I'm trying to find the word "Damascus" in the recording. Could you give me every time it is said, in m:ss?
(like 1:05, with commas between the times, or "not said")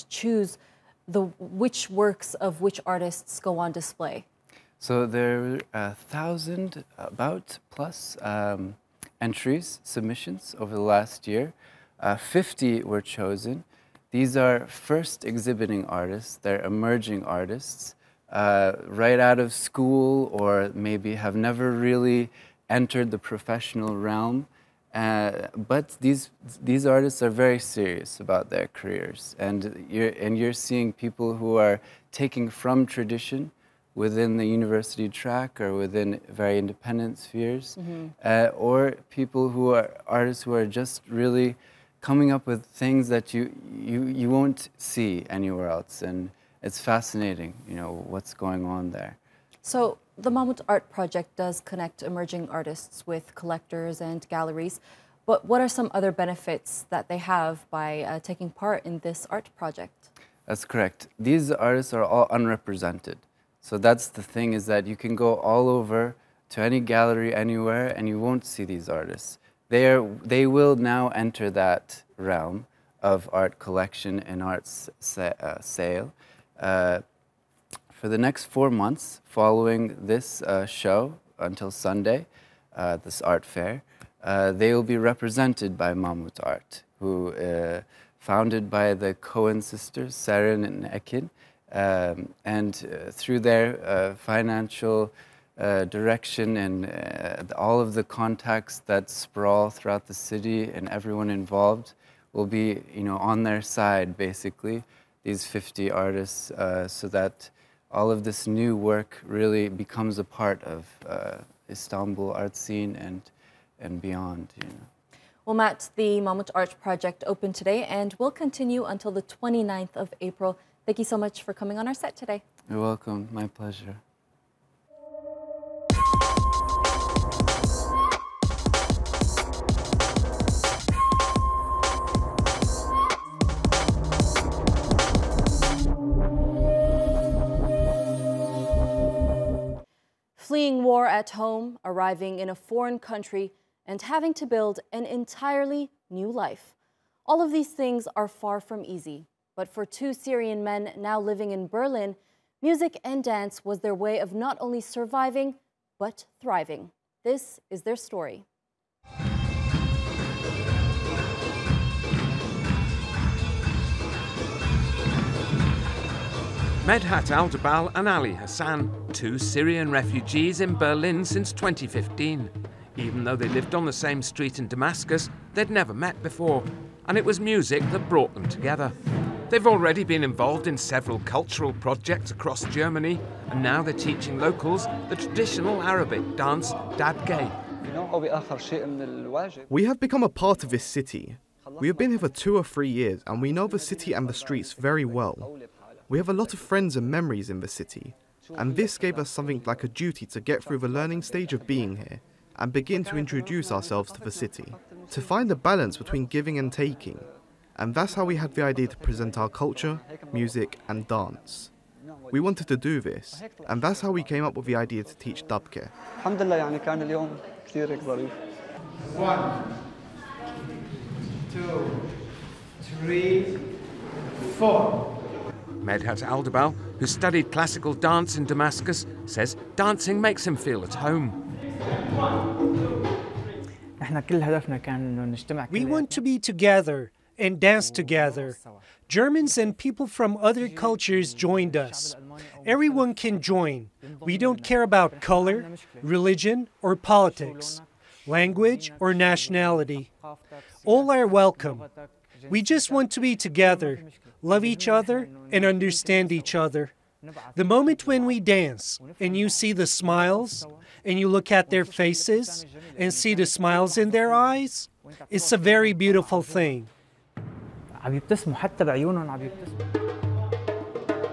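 2:54, 3:48.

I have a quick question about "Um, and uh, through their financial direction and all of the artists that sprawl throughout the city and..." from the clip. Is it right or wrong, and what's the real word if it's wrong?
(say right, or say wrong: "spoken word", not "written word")
wrong: "contacts", not "artists".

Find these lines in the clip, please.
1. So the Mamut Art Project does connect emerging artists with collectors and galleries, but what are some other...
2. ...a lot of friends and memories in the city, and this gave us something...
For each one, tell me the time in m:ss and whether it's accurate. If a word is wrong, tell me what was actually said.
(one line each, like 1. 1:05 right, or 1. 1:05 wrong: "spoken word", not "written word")
1. 0:49 right
2. 3:16 right.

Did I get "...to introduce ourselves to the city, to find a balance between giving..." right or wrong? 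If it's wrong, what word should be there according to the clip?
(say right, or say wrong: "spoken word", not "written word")
right.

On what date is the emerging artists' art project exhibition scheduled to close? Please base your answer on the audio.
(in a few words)
29 April.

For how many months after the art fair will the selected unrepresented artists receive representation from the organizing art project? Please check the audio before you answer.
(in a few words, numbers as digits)
4.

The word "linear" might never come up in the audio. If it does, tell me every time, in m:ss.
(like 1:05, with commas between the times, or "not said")
not said.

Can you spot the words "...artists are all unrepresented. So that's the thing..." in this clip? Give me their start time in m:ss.
1:01.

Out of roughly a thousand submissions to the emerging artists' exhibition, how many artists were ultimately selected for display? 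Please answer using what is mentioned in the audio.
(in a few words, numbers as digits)
50.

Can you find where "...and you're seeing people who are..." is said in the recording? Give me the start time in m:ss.
0:30.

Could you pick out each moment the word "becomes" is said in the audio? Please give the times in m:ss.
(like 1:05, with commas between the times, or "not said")
1:49, 3:09.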